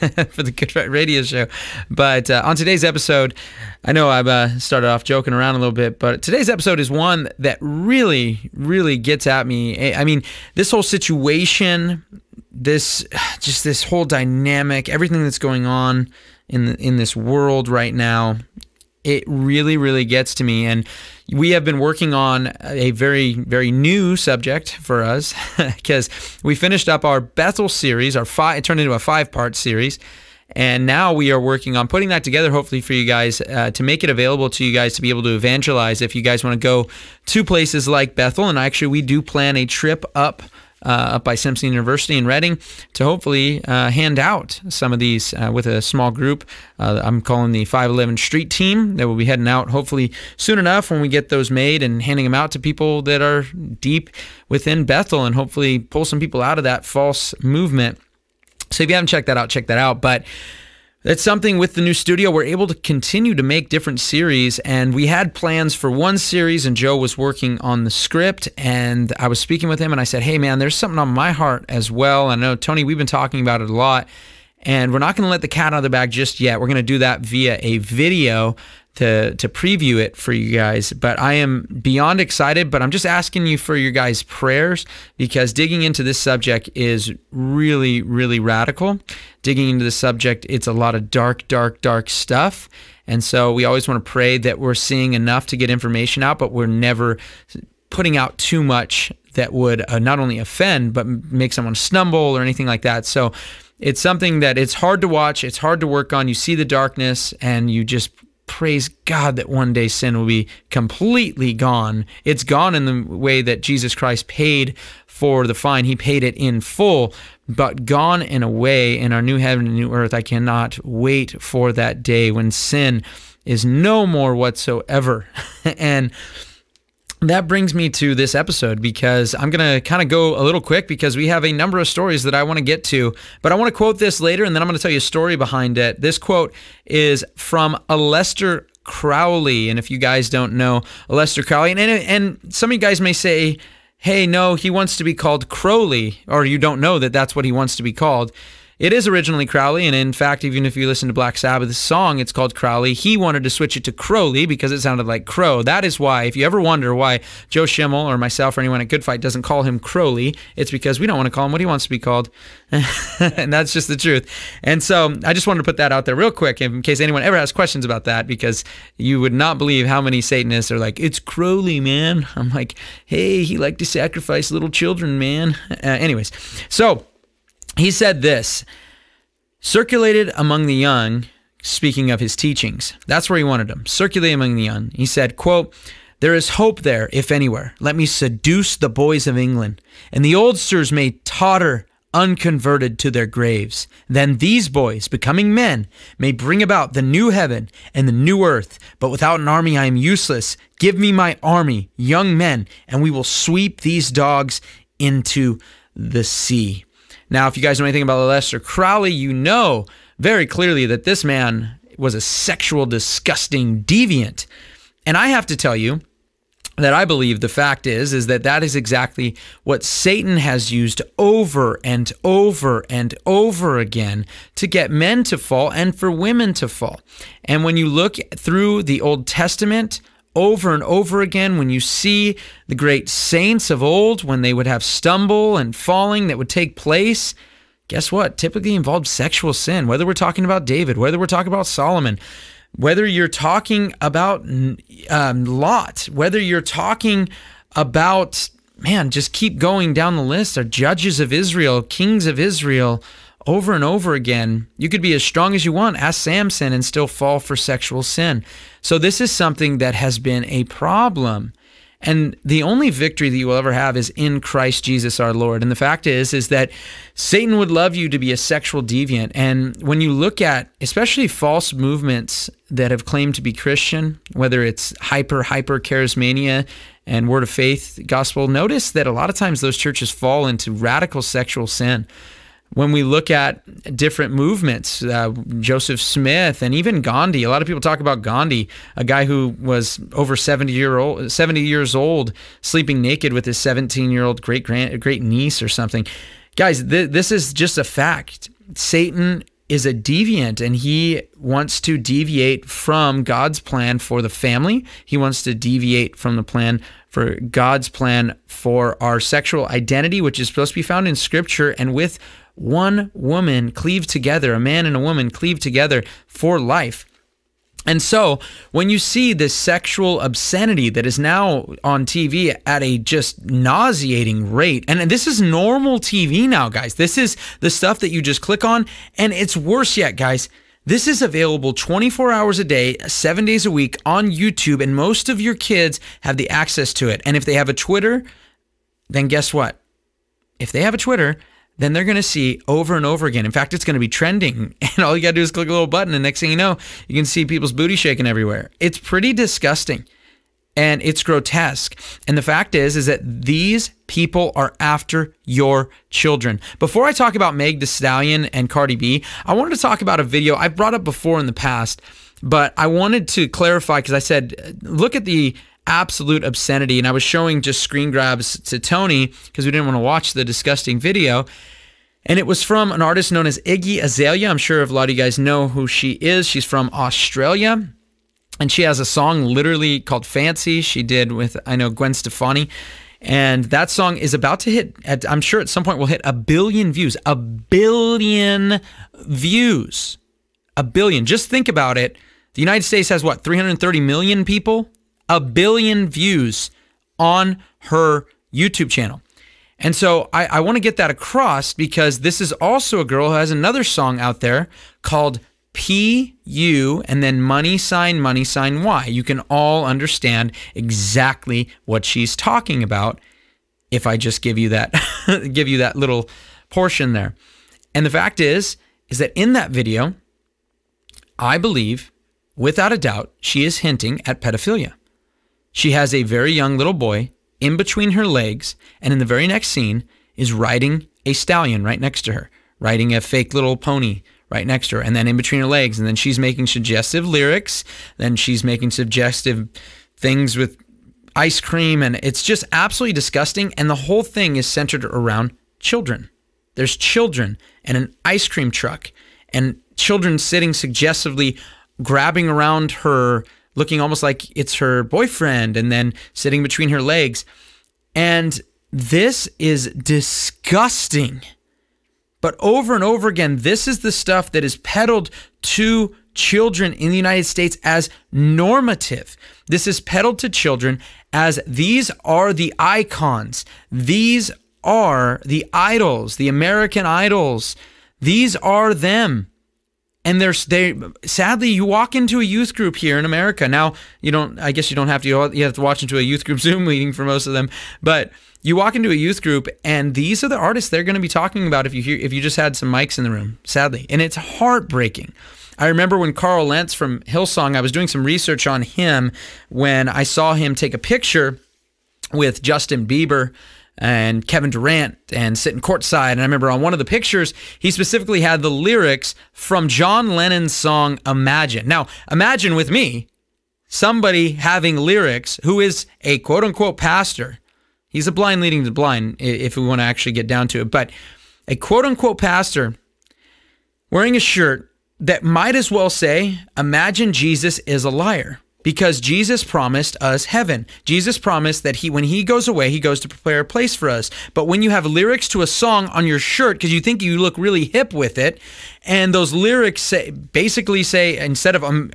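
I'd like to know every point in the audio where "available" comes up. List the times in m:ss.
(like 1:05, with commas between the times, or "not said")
0:34, 5:31.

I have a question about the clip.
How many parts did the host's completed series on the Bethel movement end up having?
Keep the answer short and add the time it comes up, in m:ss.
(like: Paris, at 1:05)
5, at 0:28.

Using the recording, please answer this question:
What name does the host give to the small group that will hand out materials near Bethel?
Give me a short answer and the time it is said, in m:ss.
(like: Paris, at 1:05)
511 Street Team, at 0:47.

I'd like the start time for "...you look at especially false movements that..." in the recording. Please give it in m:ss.
4:30.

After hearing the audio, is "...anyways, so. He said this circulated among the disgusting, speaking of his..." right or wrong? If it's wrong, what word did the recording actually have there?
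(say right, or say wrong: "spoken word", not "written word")
wrong: "young", not "disgusting".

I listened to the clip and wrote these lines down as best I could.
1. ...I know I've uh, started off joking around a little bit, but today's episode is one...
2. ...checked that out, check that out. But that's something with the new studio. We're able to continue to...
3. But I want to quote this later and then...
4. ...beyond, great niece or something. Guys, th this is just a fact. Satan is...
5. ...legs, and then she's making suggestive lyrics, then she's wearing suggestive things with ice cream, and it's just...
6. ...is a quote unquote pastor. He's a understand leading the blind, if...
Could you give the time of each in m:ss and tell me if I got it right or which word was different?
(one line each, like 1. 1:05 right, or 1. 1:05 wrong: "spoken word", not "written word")
1. 0:03 right
2. 0:59 right
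3. 2:13 right
4. 4:54 wrong: "grand", not "beyond"
5. 7:15 wrong: "making", not "wearing"
6. 8:35 wrong: "blind", not "understand".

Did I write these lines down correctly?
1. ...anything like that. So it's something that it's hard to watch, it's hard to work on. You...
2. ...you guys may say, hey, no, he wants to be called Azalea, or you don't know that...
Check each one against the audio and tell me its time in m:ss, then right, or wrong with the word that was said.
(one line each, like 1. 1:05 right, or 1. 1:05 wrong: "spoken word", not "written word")
1. 1:42 right
2. 2:22 wrong: "Crowley", not "Azalea".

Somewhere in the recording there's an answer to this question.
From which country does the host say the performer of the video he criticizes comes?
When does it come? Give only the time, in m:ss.
6:16.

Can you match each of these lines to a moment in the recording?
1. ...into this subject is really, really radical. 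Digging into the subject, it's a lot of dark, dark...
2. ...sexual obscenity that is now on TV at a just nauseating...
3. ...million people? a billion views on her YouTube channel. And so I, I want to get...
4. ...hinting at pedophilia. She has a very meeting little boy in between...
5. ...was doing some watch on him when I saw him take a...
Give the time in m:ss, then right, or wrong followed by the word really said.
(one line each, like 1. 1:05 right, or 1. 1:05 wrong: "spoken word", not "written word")
1. 1:25 right
2. 5:19 right
3. 6:34 right
4. 7:03 wrong: "young", not "meeting"
5. 8:17 wrong: "research", not "watch".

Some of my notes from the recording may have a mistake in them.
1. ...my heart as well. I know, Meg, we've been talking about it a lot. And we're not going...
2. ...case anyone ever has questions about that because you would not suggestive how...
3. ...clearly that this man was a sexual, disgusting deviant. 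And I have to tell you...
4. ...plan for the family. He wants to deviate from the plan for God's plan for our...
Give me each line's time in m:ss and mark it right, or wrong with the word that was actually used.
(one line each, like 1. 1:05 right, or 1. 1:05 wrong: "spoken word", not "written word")
1. 1:11 wrong: "Tony", not "Meg"
2. 2:46 wrong: "believe", not "suggestive"
3. 3:30 right
4. 5:03 right.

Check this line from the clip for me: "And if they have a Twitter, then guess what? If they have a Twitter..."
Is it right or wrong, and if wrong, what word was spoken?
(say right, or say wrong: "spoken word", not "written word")
right.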